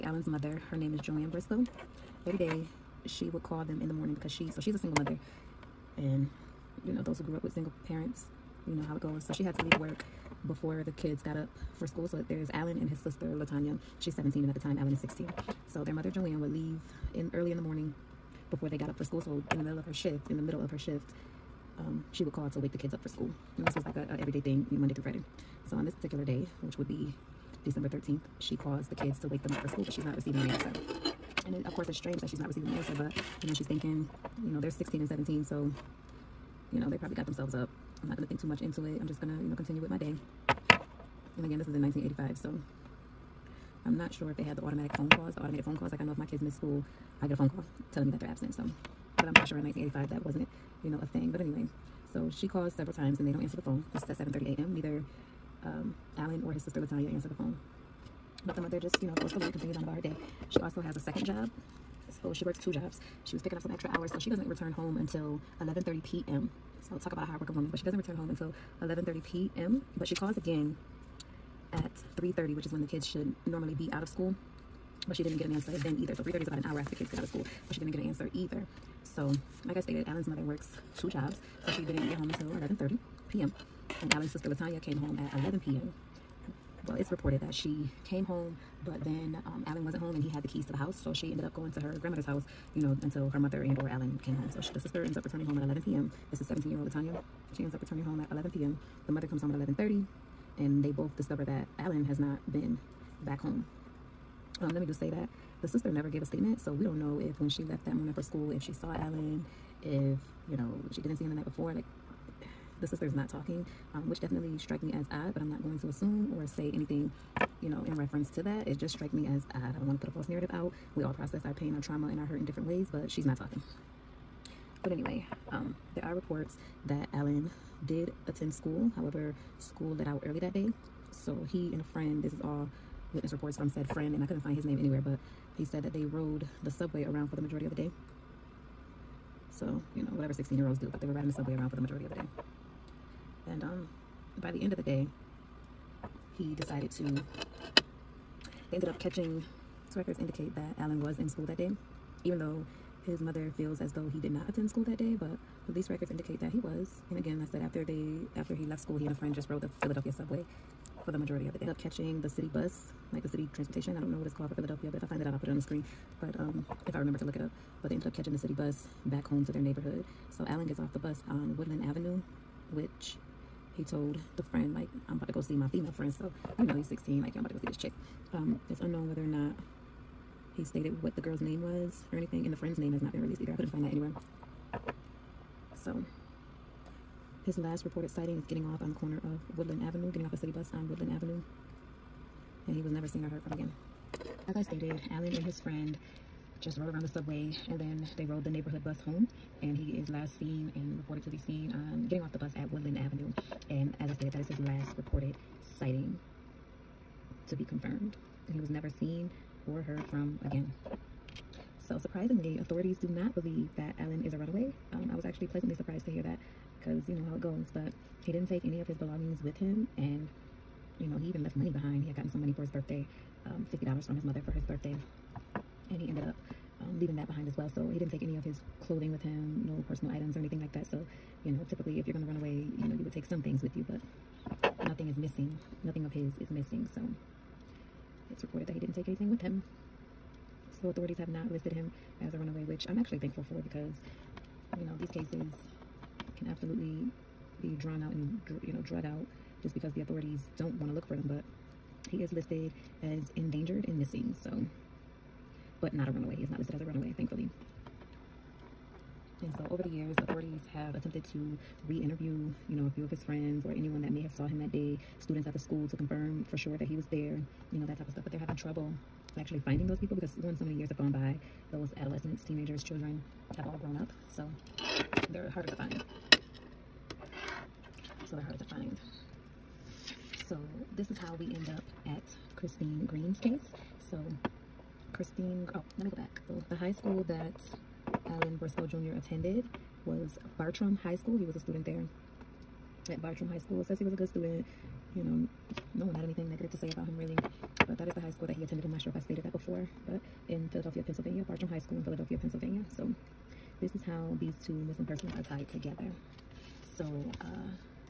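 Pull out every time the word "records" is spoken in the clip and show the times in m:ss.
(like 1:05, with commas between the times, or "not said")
2:29, 2:35.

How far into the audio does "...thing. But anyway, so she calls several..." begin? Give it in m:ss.
0:51.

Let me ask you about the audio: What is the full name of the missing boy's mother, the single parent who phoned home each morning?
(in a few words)
Joanne Briscoe.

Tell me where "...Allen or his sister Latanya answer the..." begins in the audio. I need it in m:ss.
0:56.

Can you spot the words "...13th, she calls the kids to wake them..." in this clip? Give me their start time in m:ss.
0:27.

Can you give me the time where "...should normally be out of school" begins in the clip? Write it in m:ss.
1:13.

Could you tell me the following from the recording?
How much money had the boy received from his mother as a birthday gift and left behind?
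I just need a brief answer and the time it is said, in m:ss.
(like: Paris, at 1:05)
$50, at 3:43.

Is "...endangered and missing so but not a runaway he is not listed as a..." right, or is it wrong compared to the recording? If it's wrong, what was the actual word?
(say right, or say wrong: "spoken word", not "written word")
right.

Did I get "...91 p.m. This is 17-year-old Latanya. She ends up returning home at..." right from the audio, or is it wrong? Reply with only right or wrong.
wrong.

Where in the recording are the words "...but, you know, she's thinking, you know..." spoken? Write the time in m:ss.
0:32.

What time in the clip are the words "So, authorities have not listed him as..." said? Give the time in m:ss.
4:00.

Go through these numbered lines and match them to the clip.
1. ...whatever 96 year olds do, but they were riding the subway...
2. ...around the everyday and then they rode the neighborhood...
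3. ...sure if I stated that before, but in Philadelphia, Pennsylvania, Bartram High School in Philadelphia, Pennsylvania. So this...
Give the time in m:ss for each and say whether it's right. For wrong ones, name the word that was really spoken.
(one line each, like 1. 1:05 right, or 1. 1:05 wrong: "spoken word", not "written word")
1. 2:20 wrong: "16", not "96"
2. 3:16 wrong: "subway", not "everyday"
3. 4:59 right.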